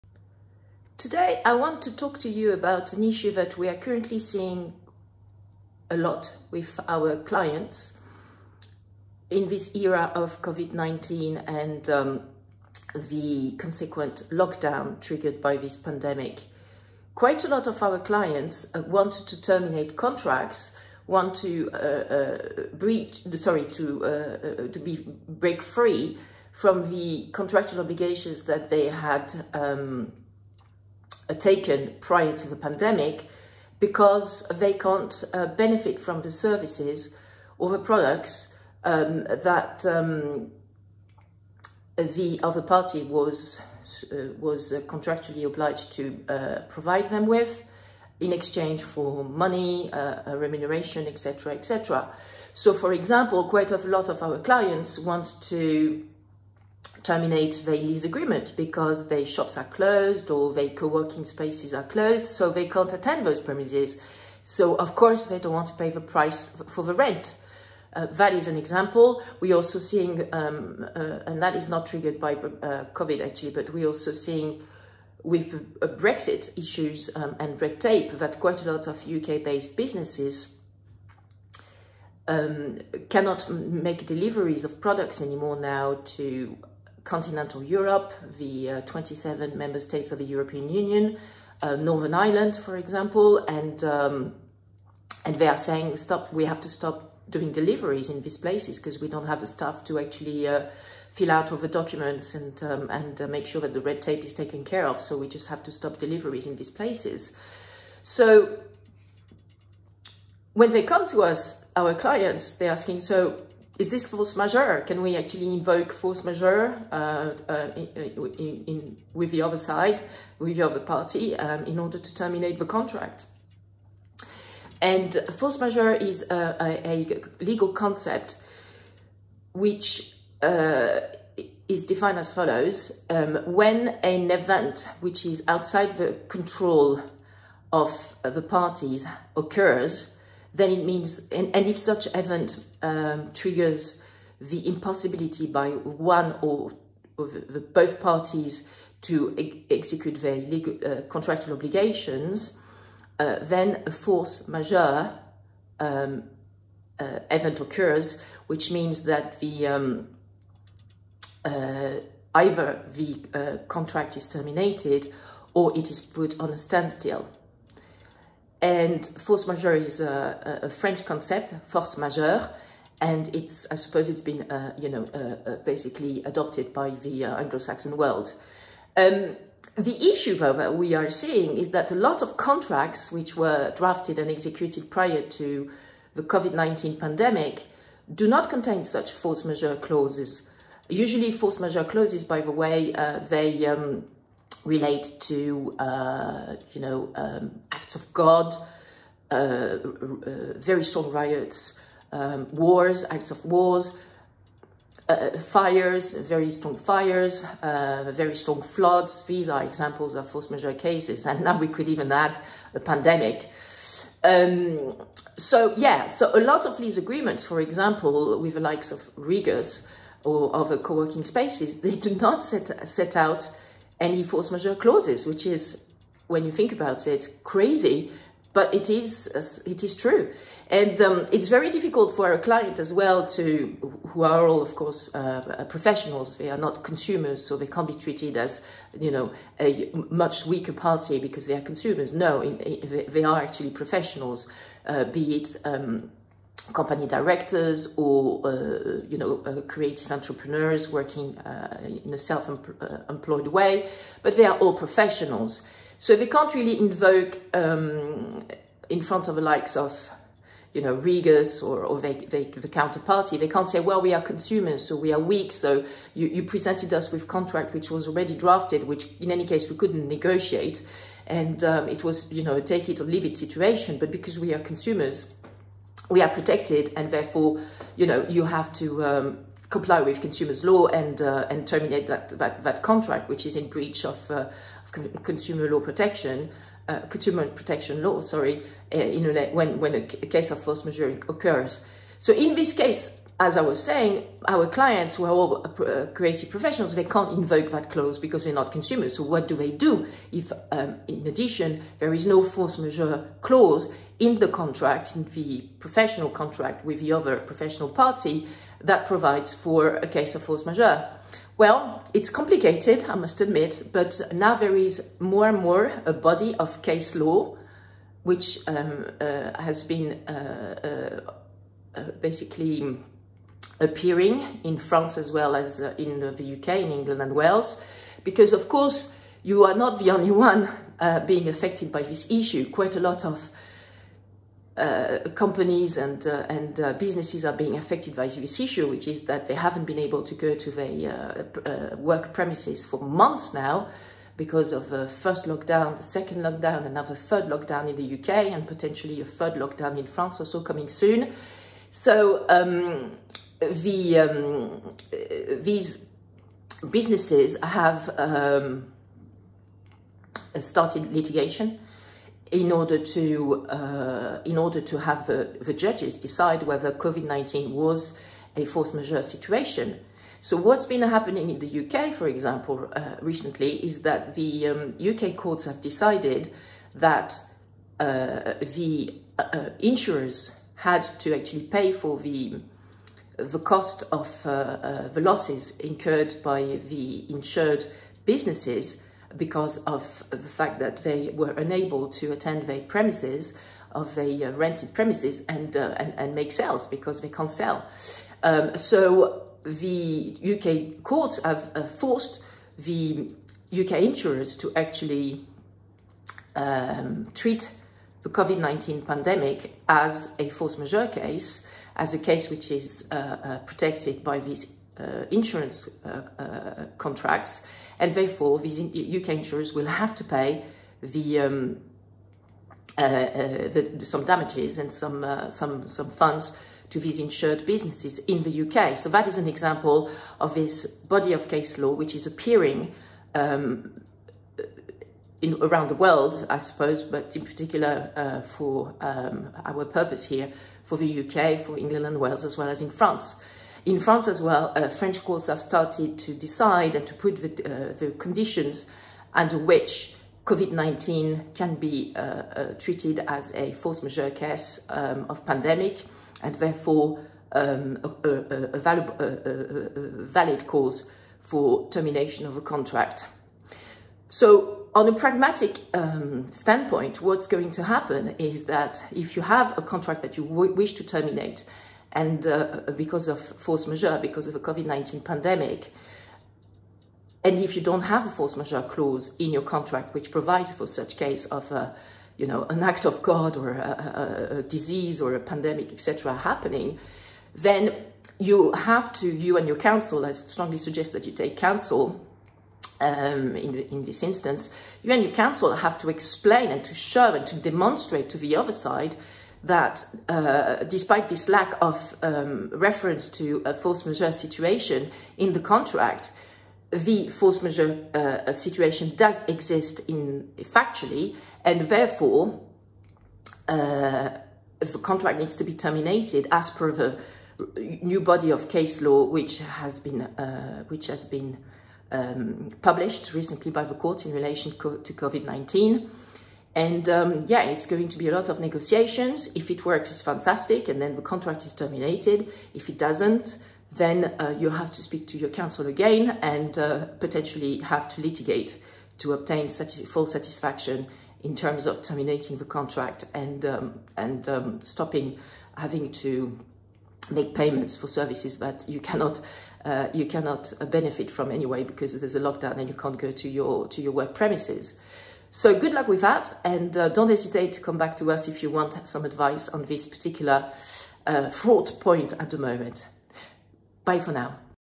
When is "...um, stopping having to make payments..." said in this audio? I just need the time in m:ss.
9:04.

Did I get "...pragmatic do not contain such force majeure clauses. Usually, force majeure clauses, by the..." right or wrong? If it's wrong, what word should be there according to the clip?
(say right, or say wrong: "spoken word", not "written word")
wrong: "pandemic", not "pragmatic".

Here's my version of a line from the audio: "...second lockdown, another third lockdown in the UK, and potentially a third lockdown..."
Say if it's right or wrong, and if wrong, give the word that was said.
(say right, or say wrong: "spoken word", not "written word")
right.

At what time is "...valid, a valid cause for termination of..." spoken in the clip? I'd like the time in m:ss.
7:38.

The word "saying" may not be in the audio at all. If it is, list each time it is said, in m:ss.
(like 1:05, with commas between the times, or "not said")
1:35, 4:53.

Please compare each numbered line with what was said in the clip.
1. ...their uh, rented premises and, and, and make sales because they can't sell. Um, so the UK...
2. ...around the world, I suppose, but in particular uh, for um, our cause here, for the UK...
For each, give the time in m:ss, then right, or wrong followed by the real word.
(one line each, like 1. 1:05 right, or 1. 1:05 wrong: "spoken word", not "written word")
1. 6:34 right
2. 7:15 wrong: "purpose", not "cause".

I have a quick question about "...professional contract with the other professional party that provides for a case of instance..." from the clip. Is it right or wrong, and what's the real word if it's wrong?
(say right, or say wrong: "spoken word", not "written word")
wrong: "force", not "instance".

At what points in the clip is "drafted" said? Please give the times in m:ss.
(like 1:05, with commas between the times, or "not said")
3:03, 4:28.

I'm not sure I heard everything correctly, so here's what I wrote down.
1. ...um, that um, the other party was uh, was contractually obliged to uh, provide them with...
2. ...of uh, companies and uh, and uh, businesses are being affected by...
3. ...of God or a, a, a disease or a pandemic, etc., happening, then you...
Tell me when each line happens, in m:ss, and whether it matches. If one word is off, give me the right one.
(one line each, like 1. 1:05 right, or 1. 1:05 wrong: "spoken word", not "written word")
1. 0:38 right
2. 5:33 right
3. 8:03 right.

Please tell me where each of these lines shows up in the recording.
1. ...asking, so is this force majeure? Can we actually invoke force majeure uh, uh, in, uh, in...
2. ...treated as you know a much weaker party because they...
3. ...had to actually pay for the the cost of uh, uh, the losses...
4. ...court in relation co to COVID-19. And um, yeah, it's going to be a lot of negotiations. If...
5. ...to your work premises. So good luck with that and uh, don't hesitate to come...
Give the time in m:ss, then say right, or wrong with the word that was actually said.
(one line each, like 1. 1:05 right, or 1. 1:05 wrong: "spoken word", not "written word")
1. 1:52 right
2. 3:57 right
3. 6:20 right
4. 8:43 right
5. 9:13 right.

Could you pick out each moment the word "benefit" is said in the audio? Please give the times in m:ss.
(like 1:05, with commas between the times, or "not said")
0:35, 9:10.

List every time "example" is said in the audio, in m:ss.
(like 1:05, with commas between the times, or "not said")
0:52, 1:08, 1:32, 3:29, 3:37, 6:12, 7:09.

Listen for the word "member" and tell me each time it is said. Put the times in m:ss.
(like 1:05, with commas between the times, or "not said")
1:29.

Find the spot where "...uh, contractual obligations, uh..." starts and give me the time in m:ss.
2:30.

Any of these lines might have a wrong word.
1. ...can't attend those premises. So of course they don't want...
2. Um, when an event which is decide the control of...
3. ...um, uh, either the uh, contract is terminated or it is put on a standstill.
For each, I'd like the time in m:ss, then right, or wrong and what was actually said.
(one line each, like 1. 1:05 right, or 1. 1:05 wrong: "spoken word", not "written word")
1. 1:02 right
2. 2:13 wrong: "outside", not "decide"
3. 2:39 right.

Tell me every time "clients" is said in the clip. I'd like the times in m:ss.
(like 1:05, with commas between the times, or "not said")
0:07, 0:17, 0:54, 1:51, 3:52, 4:54.